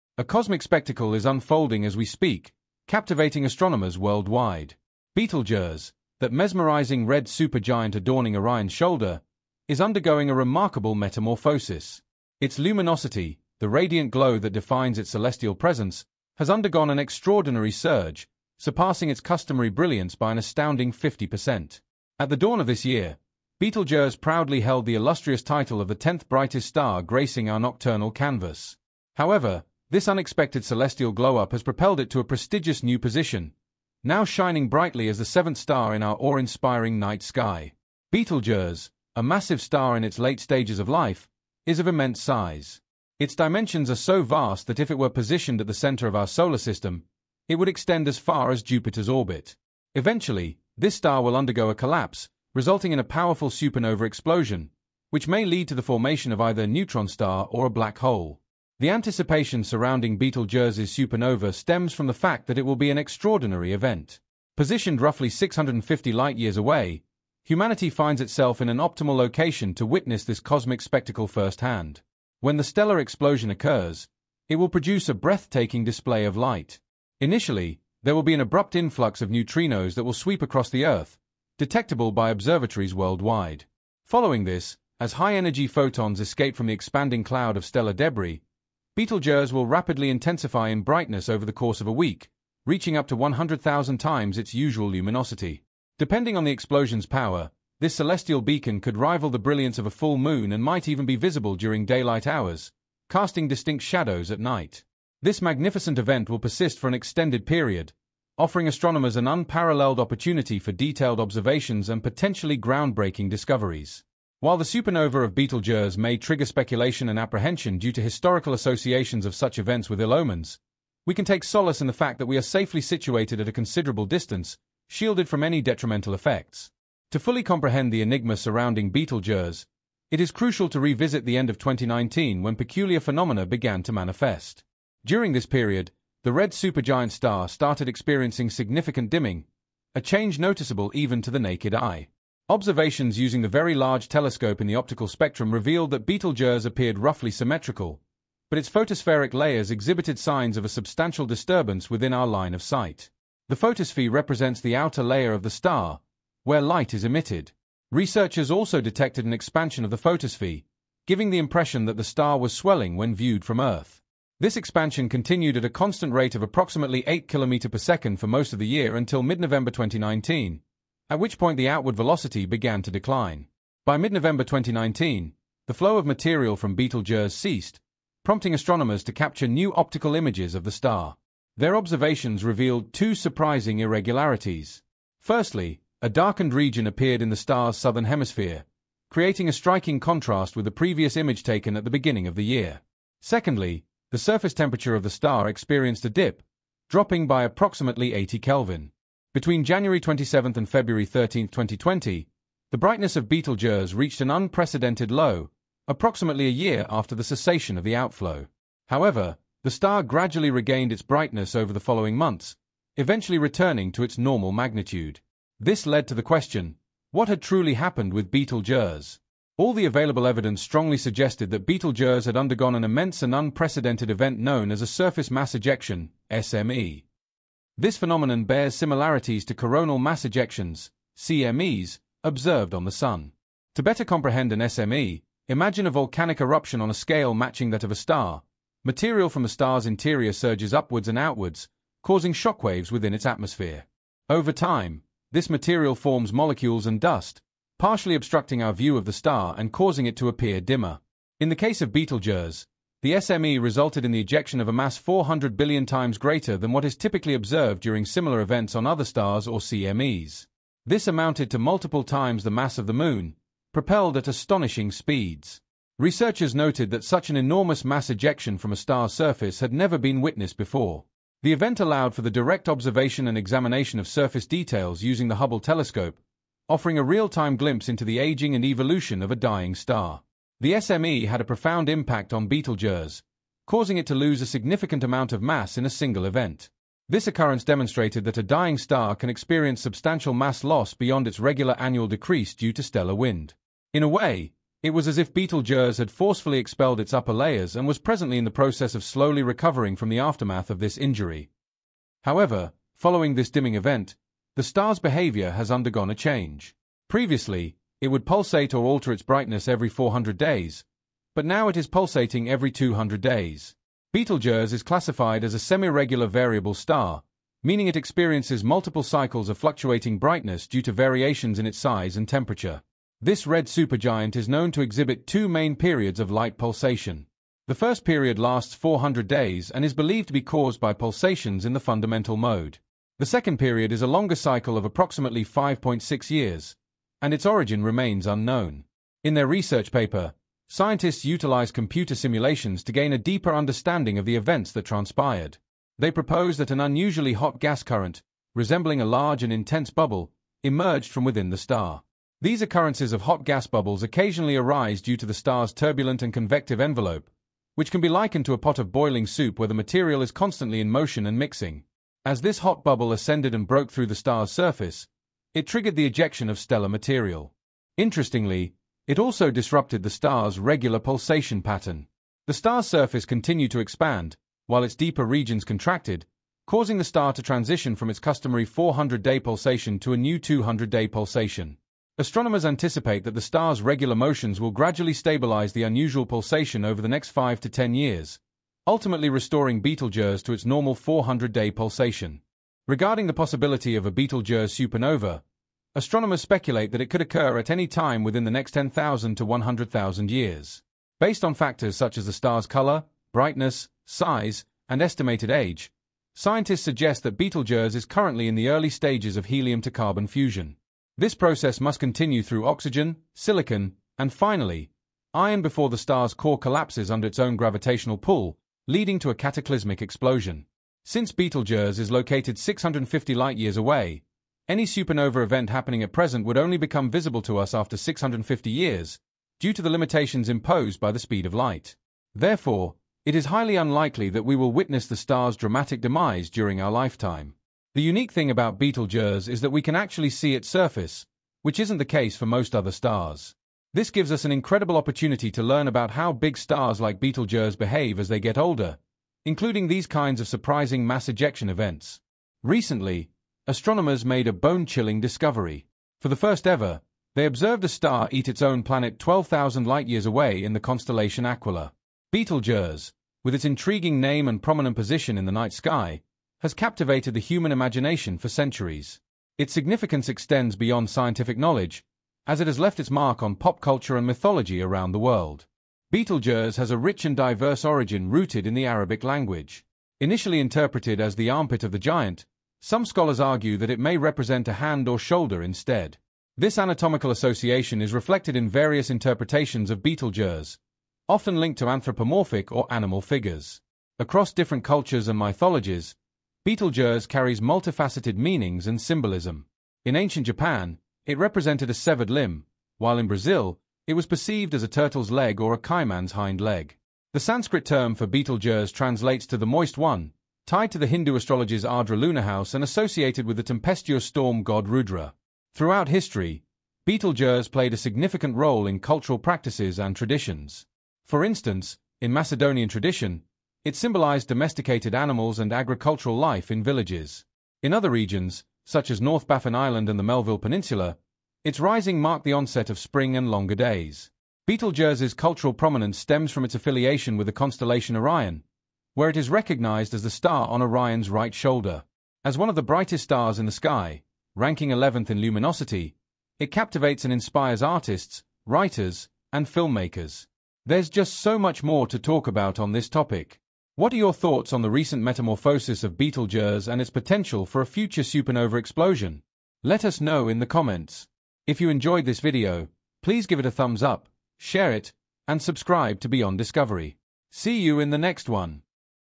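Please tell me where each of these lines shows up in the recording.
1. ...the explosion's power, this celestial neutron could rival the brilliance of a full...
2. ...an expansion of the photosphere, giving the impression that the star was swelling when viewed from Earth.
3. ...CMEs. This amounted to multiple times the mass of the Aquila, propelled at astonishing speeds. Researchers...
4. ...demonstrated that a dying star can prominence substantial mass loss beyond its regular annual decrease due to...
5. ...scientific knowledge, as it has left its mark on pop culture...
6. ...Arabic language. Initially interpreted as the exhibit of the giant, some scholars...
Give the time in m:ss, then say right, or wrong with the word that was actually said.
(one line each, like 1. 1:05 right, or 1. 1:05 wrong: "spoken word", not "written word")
1. 1:36 wrong: "beacon", not "neutron"
2. 2:39 right
3. 4:19 wrong: "Moon", not "Aquila"
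4. 4:47 wrong: "experience", not "prominence"
5. 7:51 right
6. 7:58 wrong: "armpit", not "exhibit".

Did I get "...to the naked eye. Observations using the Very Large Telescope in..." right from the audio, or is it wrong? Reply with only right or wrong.
right.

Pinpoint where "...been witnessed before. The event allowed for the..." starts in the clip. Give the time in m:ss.
4:29.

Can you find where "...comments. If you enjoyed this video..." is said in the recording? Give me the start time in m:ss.
9:20.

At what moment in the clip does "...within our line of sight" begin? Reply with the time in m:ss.
2:31.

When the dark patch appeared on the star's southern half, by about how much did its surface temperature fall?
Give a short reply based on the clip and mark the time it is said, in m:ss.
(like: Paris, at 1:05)
80 Kelvin, at 3:18.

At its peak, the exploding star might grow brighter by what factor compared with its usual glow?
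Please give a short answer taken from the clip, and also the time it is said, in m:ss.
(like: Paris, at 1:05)
100,000 times, at 1:33.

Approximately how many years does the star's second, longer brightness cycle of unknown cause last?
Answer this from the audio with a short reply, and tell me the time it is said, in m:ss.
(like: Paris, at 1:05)
5.6 years, at 5:35.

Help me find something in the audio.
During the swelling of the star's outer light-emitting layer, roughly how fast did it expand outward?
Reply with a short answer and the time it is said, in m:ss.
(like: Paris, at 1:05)
8 km per second, at 2:47.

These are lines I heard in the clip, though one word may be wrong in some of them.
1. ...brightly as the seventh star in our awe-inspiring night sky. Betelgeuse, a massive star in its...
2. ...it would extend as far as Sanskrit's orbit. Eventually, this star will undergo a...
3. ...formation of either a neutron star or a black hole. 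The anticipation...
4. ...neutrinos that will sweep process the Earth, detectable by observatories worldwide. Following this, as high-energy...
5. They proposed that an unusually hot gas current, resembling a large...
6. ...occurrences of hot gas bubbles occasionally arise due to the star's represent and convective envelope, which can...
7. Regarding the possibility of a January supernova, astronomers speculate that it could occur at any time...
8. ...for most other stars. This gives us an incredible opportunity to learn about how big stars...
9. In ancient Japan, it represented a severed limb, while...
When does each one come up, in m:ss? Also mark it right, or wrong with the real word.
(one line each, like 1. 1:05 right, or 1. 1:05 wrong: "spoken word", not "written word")
1. 0:34 right
2. 0:47 wrong: "Jupiter", not "Sanskrit"
3. 0:55 right
4. 1:19 wrong: "across", not "process"
5. 5:45 right
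6. 5:52 wrong: "turbulent", not "represent"
7. 6:32 wrong: "Betelgeuse", not "January"
8. 7:22 right
9. 8:20 right.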